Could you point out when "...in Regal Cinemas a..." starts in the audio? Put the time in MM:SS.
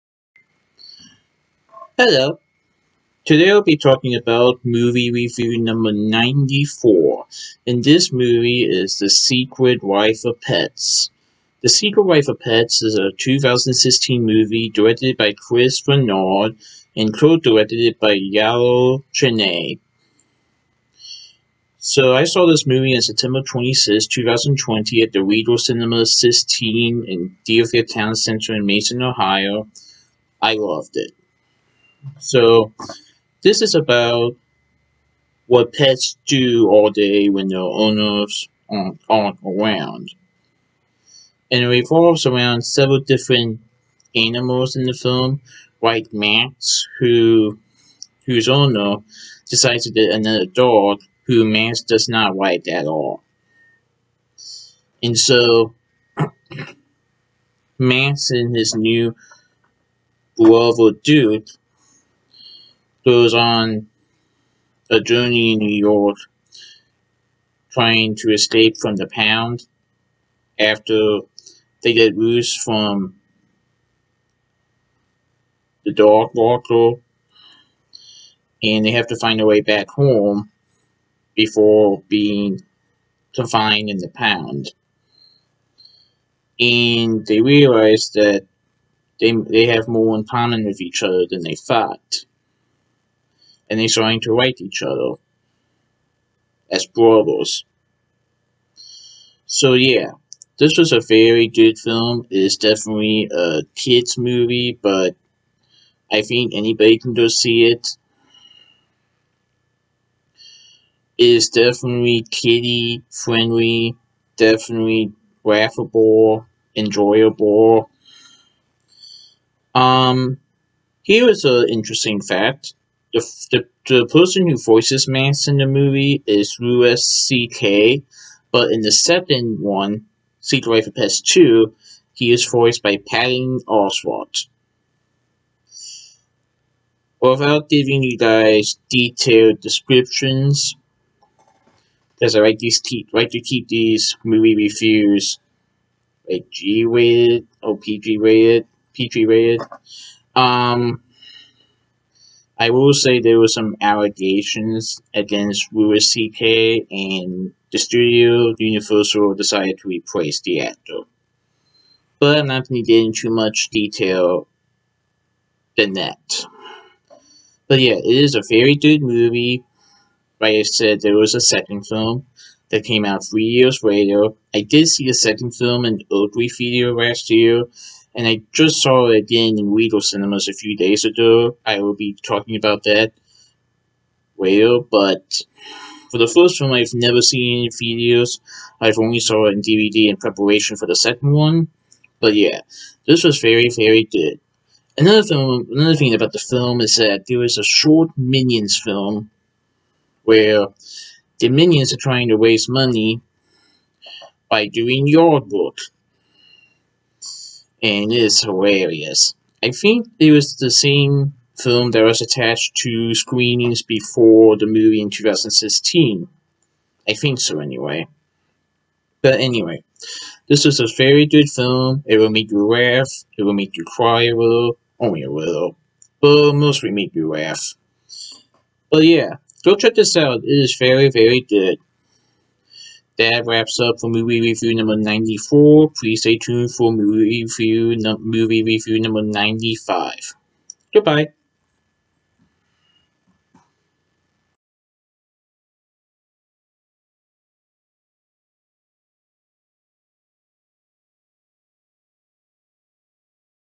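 02:59.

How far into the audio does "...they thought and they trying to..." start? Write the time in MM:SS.
01:31.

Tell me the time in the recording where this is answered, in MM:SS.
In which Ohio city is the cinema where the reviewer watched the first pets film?
00:28.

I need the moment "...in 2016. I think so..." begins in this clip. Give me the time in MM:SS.
03:35.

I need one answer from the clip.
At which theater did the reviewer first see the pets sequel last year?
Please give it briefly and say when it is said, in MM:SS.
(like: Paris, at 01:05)
Oakley Theater, at 02:56.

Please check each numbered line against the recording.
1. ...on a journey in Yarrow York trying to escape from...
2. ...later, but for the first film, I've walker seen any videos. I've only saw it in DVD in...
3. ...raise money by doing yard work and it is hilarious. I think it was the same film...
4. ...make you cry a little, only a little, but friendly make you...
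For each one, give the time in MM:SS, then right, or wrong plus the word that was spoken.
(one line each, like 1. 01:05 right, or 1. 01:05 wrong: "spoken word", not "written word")
1. 01:03 wrong: "New", not "Yarrow"
2. 03:04 wrong: "never", not "walker"
3. 03:22 right
4. 03:43 wrong: "mostly", not "friendly".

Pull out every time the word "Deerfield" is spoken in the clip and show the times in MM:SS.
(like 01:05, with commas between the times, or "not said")
00:27.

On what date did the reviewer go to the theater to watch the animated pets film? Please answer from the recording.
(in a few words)
September 26, 2020.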